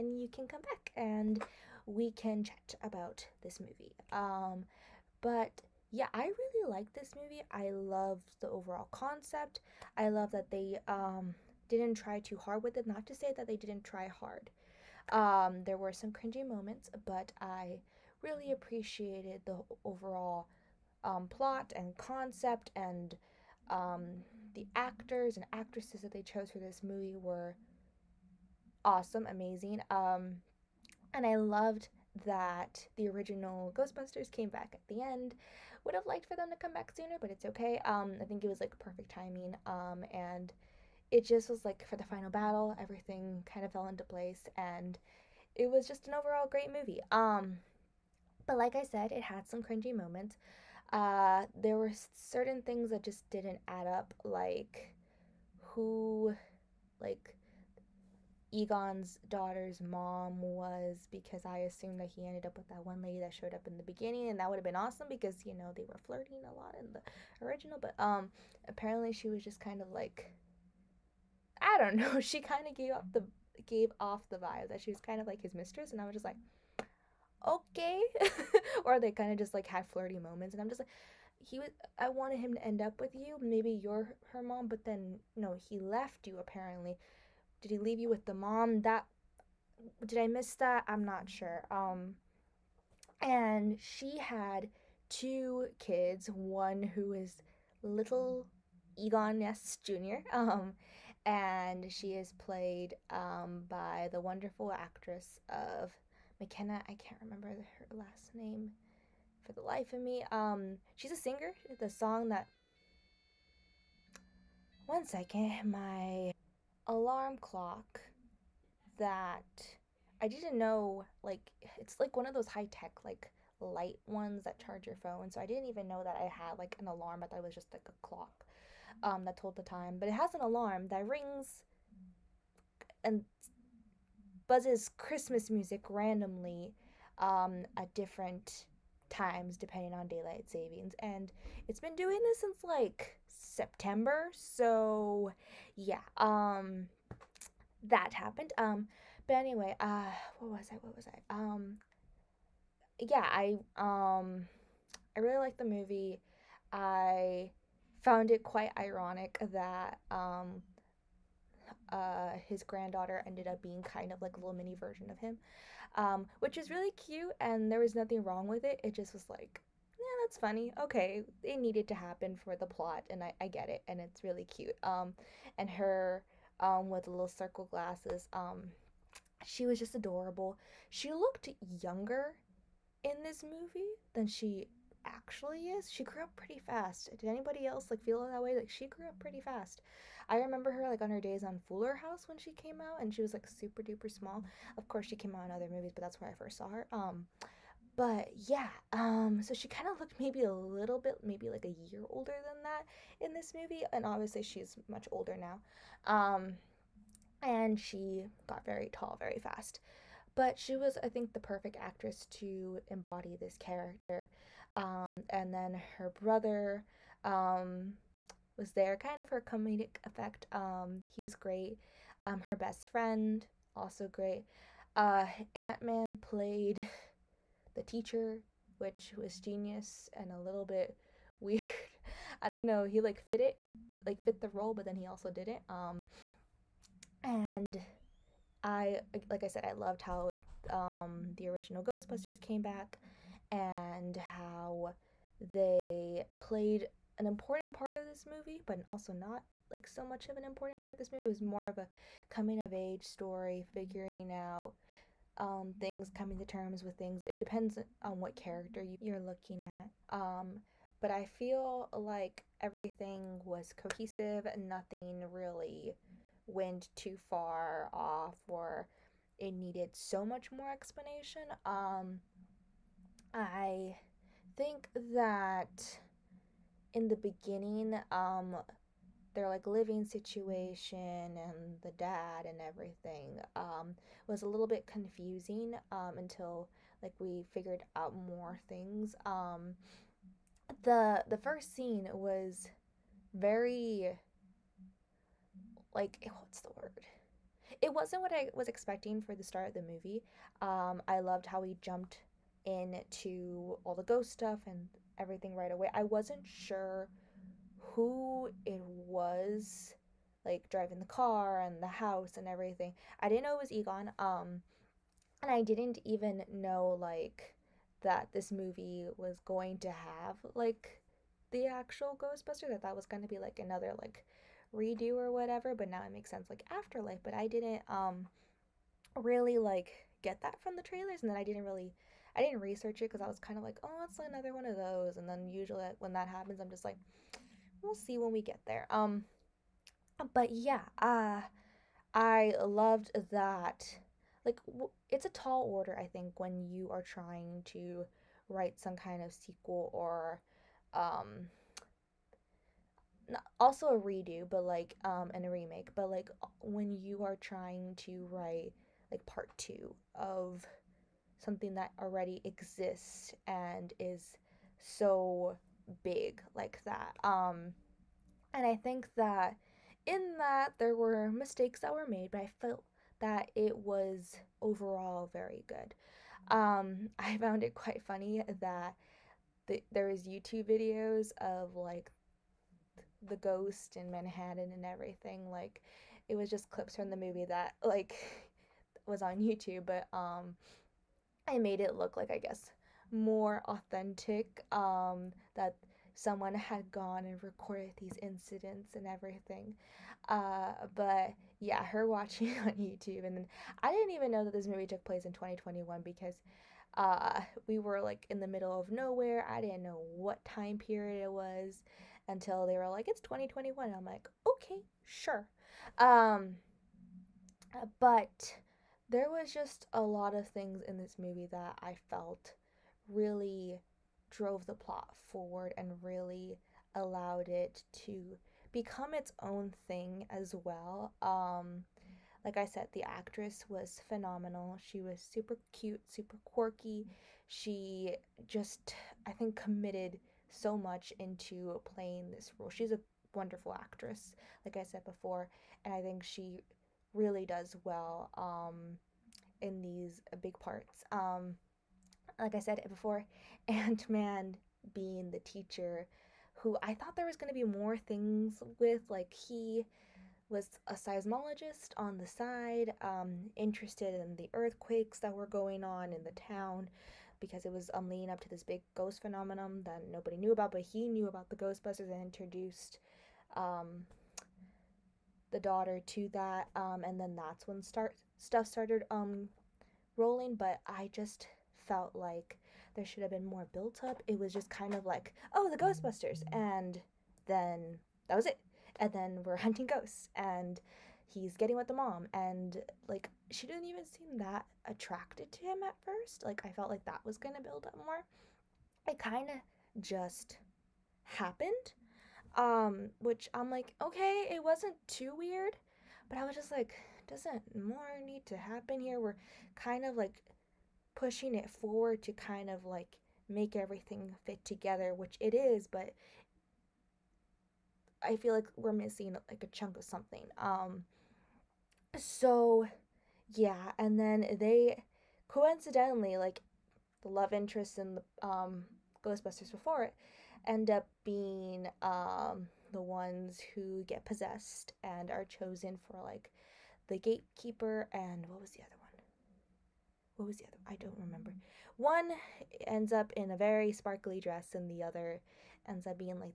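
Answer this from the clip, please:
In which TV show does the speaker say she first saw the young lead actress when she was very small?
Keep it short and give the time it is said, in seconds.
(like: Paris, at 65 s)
Fuller House, at 191 s.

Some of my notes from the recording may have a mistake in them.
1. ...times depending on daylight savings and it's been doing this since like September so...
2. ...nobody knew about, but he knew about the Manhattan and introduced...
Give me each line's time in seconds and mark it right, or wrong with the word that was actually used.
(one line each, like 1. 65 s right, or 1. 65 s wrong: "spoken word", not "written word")
1. 139 s right
2. 470 s wrong: "Ghostbusters", not "Manhattan".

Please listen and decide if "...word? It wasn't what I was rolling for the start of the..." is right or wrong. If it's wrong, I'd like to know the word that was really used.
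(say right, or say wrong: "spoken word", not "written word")
wrong: "expecting", not "rolling".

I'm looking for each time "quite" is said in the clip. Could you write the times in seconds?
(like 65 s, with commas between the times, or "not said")
158 s, 377 s.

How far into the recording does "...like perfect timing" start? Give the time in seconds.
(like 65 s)
38 s.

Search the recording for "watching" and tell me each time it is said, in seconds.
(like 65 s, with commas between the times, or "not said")
402 s.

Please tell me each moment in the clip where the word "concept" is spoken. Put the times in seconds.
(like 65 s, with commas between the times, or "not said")
8 s, 21 s.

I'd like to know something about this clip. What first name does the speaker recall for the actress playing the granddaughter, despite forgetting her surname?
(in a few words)
McKenna.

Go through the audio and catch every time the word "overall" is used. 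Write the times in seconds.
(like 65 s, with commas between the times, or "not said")
8 s, 19 s, 46 s, 374 s.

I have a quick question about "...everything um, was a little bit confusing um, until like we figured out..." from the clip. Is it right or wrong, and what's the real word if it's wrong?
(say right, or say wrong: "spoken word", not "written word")
right.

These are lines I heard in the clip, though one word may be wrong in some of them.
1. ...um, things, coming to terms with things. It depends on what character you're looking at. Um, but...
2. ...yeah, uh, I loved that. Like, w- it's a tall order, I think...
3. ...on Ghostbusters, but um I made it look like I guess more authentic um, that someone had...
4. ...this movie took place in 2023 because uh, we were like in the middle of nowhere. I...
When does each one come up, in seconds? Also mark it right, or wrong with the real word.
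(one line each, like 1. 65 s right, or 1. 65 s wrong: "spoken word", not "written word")
1. 255 s right
2. 340 s right
3. 389 s wrong: "YouTube", not "Ghostbusters"
4. 404 s wrong: "2021", not "2023".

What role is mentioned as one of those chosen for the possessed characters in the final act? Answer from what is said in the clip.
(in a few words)
Gatekeeper.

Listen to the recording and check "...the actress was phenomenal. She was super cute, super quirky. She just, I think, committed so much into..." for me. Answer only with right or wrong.
right.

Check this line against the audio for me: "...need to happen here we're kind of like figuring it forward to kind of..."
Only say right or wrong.
wrong.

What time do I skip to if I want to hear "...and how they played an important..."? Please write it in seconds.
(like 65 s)
243 s.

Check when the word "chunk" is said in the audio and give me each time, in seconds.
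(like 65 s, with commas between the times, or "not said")
519 s.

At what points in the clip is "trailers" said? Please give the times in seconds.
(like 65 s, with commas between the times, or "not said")
330 s.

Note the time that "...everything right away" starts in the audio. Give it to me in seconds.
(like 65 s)
305 s.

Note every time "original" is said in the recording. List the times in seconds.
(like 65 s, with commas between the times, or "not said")
33 s, 67 s, 241 s.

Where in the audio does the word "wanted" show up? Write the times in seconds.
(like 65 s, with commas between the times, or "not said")
82 s.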